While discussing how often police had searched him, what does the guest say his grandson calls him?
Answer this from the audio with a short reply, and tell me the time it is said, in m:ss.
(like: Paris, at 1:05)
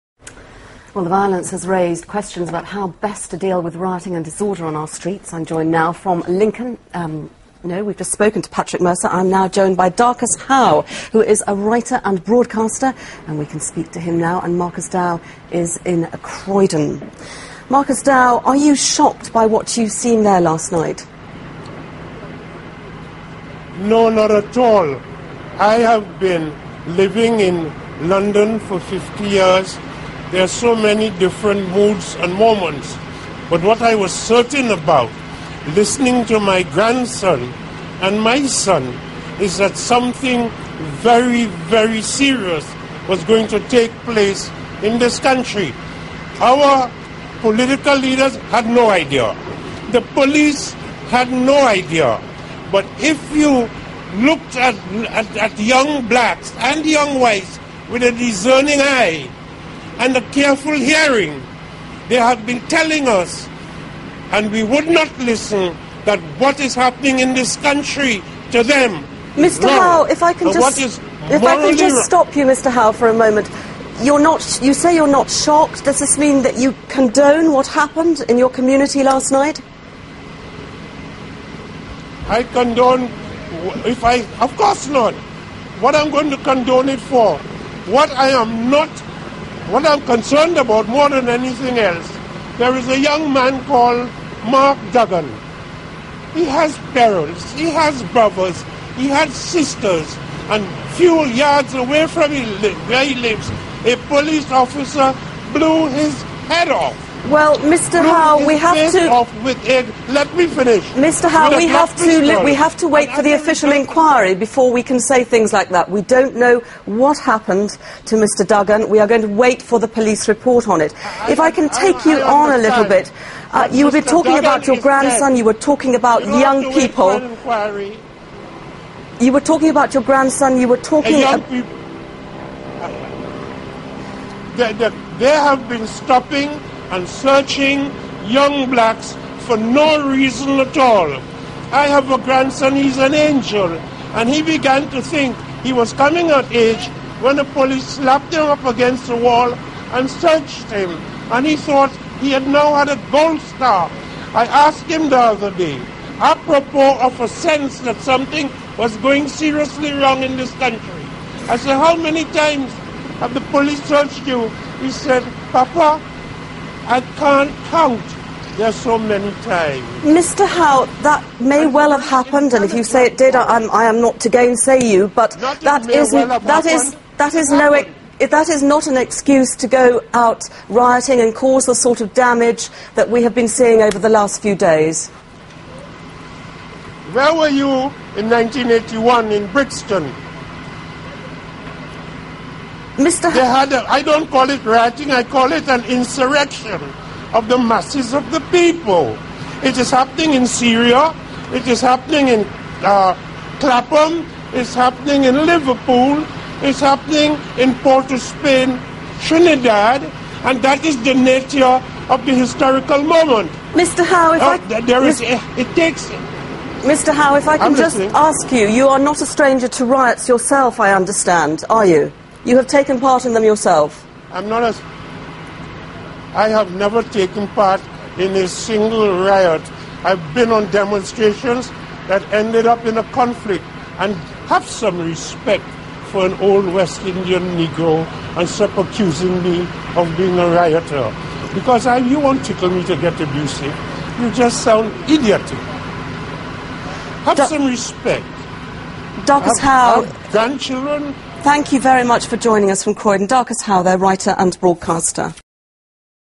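Papa, at 2:45.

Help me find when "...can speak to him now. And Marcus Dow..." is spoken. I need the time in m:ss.
0:13.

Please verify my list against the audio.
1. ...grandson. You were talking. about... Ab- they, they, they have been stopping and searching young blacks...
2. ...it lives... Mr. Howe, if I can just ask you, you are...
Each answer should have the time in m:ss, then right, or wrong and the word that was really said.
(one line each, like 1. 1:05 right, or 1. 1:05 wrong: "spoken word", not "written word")
1. 2:10 right
2. 3:35 wrong: "takes", not "lives".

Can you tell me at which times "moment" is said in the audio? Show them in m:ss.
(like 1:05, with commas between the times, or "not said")
0:32, 1:13, 3:33.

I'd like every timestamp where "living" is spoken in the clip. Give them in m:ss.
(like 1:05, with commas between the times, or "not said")
0:26.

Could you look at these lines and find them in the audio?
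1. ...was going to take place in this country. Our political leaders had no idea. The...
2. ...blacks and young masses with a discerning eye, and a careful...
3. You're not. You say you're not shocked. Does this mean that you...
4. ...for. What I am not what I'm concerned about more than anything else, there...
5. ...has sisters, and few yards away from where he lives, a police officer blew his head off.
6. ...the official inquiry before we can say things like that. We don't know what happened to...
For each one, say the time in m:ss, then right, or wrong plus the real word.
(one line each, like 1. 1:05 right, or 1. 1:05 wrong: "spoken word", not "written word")
1. 0:43 right
2. 0:56 wrong: "whites", not "masses"
3. 1:14 right
4. 1:26 right
5. 1:39 right
6. 1:53 right.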